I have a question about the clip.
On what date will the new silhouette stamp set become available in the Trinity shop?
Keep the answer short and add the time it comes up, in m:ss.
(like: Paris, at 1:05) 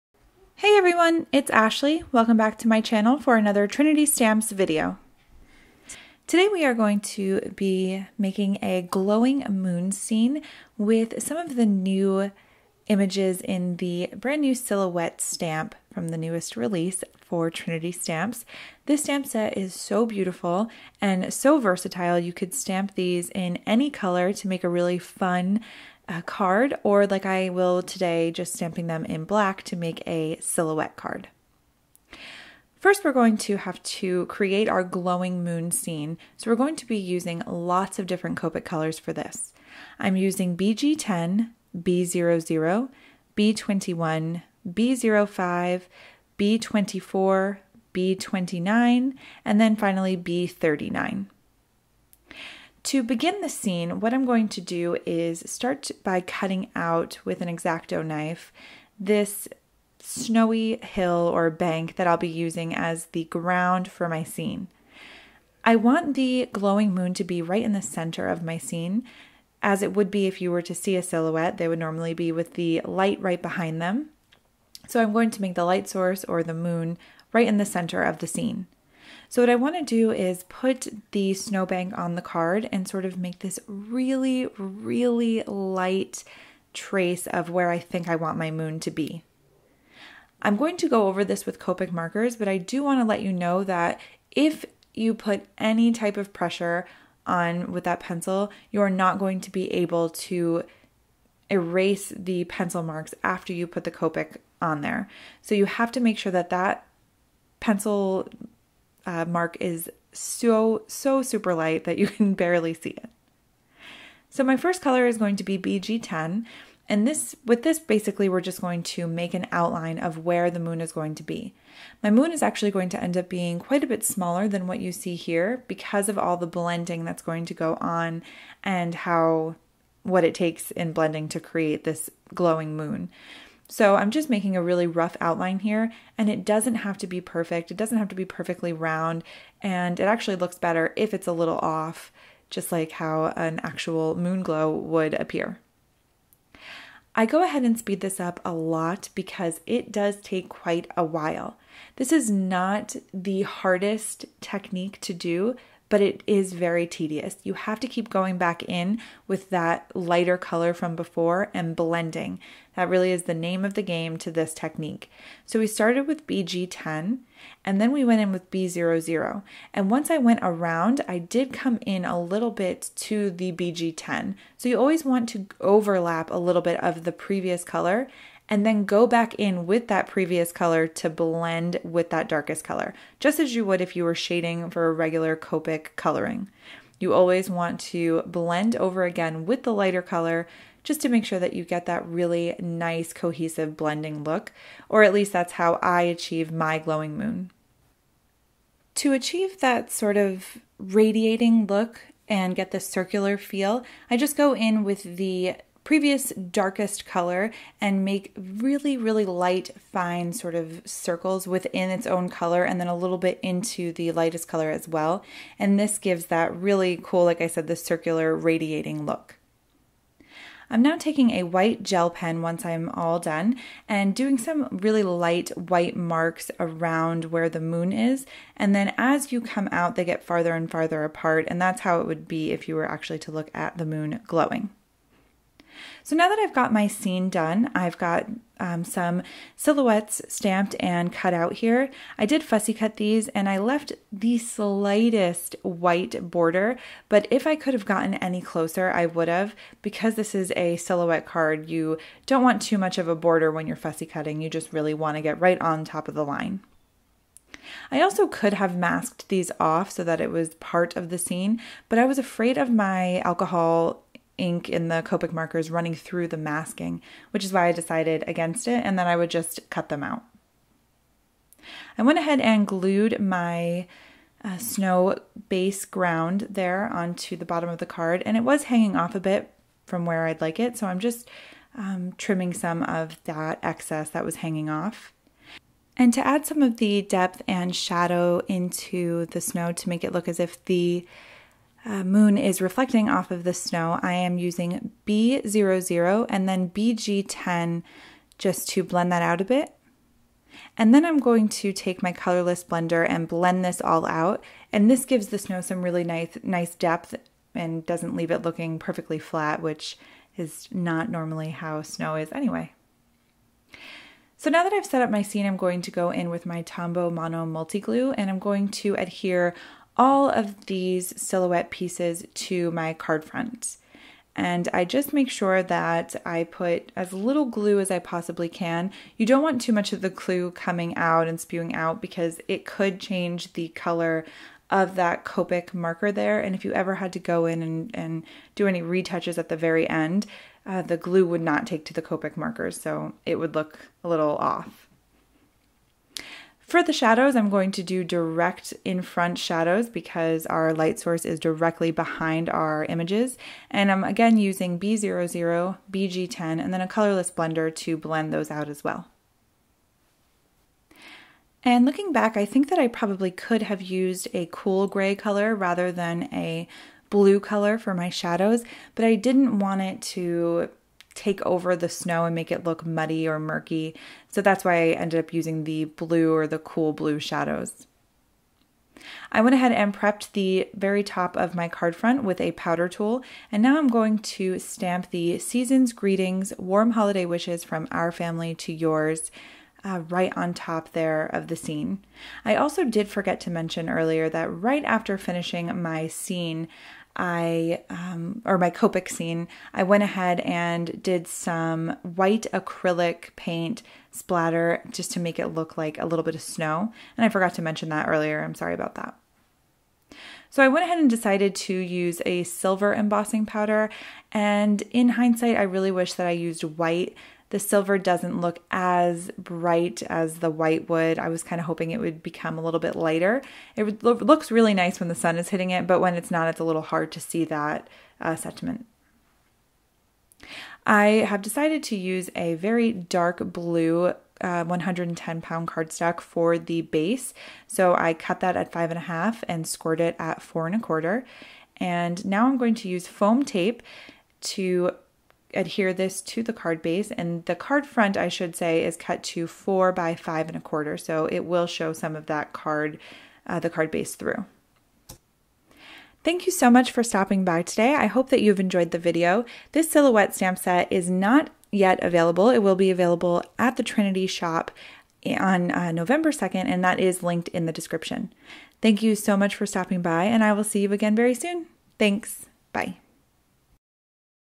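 November 2nd, at 7:45.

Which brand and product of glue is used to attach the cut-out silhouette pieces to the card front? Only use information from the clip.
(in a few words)
Tombow Mono Multi Glue.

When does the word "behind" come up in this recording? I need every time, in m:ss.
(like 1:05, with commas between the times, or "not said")
1:13, 5:51.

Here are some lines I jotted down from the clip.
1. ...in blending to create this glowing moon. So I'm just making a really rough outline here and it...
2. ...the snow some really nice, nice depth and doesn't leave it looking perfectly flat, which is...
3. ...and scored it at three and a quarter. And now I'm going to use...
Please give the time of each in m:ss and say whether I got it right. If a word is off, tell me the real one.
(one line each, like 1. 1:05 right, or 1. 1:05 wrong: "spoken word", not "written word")
1. 2:10 right
2. 5:05 right
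3. 7:19 wrong: "four", not "three".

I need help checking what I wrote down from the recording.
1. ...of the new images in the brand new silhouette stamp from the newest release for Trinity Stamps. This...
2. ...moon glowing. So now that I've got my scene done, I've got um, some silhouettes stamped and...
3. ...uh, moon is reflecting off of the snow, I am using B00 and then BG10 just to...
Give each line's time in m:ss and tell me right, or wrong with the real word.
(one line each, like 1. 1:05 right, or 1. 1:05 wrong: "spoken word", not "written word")
1. 0:11 right
2. 3:53 right
3. 4:51 right.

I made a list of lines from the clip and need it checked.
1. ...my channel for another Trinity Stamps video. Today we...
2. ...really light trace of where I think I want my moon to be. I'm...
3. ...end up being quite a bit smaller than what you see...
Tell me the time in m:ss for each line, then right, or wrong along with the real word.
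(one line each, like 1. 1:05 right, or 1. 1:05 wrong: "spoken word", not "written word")
1. 0:02 right
2. 1:24 right
3. 2:03 right.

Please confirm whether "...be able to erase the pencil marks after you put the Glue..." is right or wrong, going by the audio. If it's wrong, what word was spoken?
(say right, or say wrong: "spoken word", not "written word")
wrong: "Copic", not "Glue".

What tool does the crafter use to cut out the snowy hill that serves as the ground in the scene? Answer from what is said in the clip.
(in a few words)
X-Acto knife.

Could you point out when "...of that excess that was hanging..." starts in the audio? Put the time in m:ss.
4:42.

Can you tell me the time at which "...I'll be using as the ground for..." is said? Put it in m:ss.
1:02.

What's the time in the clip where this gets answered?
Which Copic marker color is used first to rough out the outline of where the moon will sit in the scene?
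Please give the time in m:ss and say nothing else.
1:54.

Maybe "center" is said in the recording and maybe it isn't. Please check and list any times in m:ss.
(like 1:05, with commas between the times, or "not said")
1:07, 1:17.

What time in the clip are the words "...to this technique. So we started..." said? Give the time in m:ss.
2:44.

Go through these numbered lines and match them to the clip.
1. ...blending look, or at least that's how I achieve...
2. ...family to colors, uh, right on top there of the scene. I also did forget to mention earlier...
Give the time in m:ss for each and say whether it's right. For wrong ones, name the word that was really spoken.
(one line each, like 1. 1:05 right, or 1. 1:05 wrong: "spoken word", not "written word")
1. 3:13 right
2. 6:28 wrong: "yours", not "colors".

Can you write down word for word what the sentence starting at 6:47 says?
And I forgot to mention that earlier.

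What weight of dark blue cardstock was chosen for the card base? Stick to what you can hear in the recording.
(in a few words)
110 pound.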